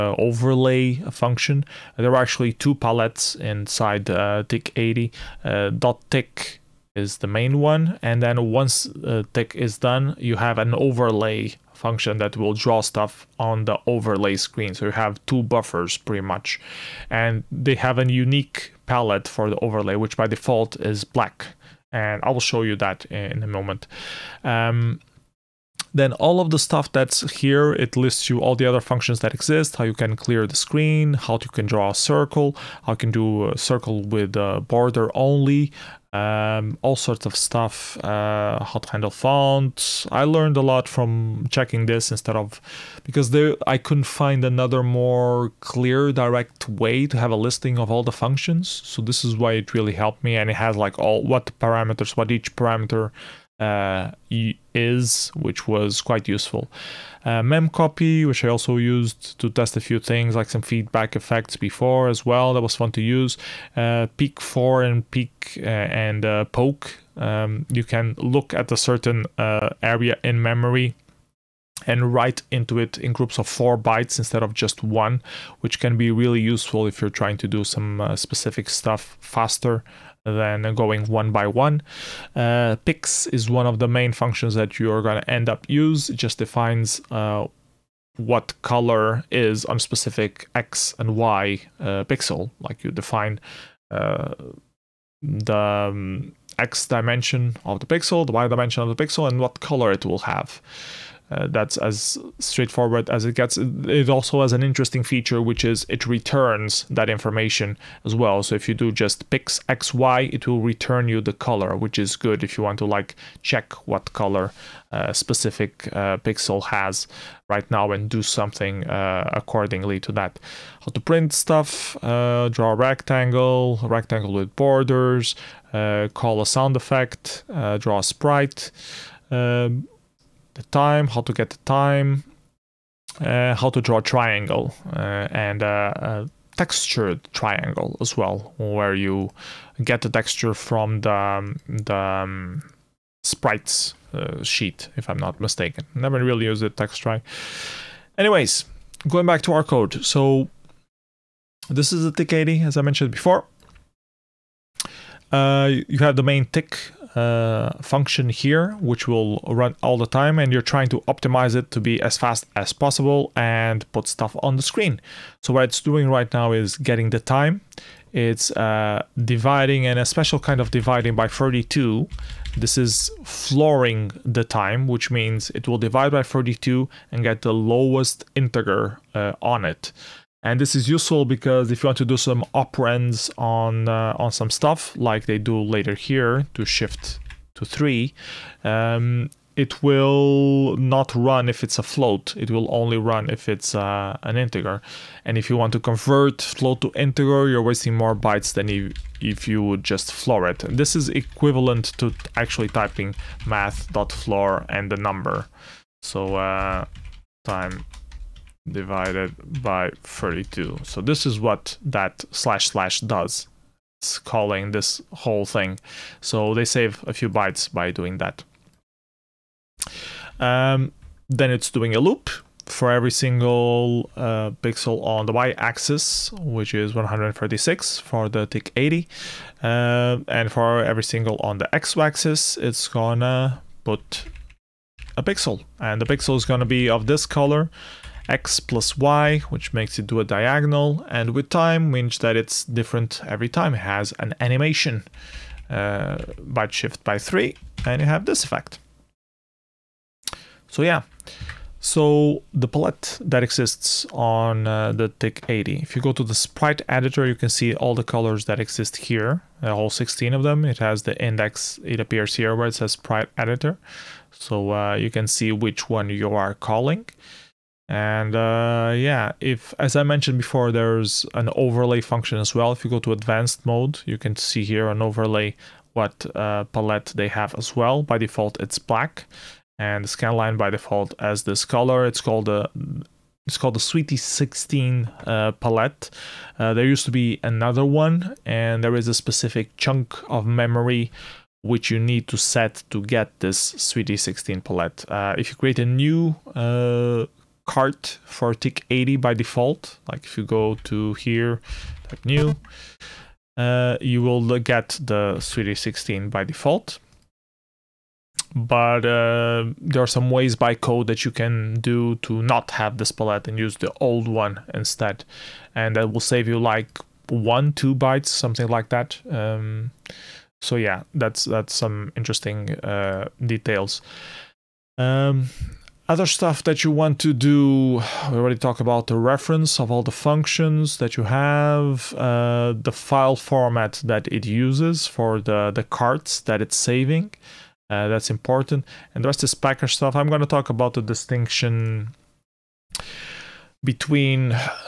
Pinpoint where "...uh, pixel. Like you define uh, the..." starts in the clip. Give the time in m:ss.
1:31.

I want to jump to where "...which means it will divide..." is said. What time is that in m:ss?
2:54.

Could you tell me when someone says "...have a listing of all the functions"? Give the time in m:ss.
0:47.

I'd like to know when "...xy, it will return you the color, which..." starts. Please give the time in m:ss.
1:49.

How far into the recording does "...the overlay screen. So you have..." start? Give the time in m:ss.
0:13.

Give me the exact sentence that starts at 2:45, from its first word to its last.
So what it's doing right now is getting the time.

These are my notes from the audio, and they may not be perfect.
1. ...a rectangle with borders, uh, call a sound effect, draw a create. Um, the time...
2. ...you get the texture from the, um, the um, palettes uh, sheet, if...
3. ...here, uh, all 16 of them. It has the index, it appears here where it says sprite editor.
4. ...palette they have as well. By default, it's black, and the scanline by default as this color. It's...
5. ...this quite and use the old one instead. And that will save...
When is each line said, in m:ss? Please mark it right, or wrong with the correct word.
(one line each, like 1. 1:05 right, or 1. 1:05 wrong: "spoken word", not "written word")
1. 2:03 wrong: "sprite", not "create"
2. 2:18 wrong: "sprites", not "palettes"
3. 4:18 right
4. 4:36 right
5. 5:12 wrong: "palette", not "quite".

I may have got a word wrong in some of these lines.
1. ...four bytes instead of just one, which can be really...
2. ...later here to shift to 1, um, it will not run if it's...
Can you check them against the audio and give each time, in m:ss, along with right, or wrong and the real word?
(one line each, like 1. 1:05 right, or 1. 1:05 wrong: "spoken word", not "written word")
1. 1:13 right
2. 3:05 wrong: "3", not "1".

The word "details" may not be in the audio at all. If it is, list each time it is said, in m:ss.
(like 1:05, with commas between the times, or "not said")
5:23.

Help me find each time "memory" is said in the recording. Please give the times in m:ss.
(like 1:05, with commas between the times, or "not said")
1:10, 4:50.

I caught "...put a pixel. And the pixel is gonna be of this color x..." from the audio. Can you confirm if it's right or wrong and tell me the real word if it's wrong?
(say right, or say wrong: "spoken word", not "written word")
right.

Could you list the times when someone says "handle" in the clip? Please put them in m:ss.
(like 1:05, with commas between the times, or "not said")
0:38.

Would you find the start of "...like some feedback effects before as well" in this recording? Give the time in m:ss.
1:00.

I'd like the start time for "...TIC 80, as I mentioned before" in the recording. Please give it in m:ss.
2:32.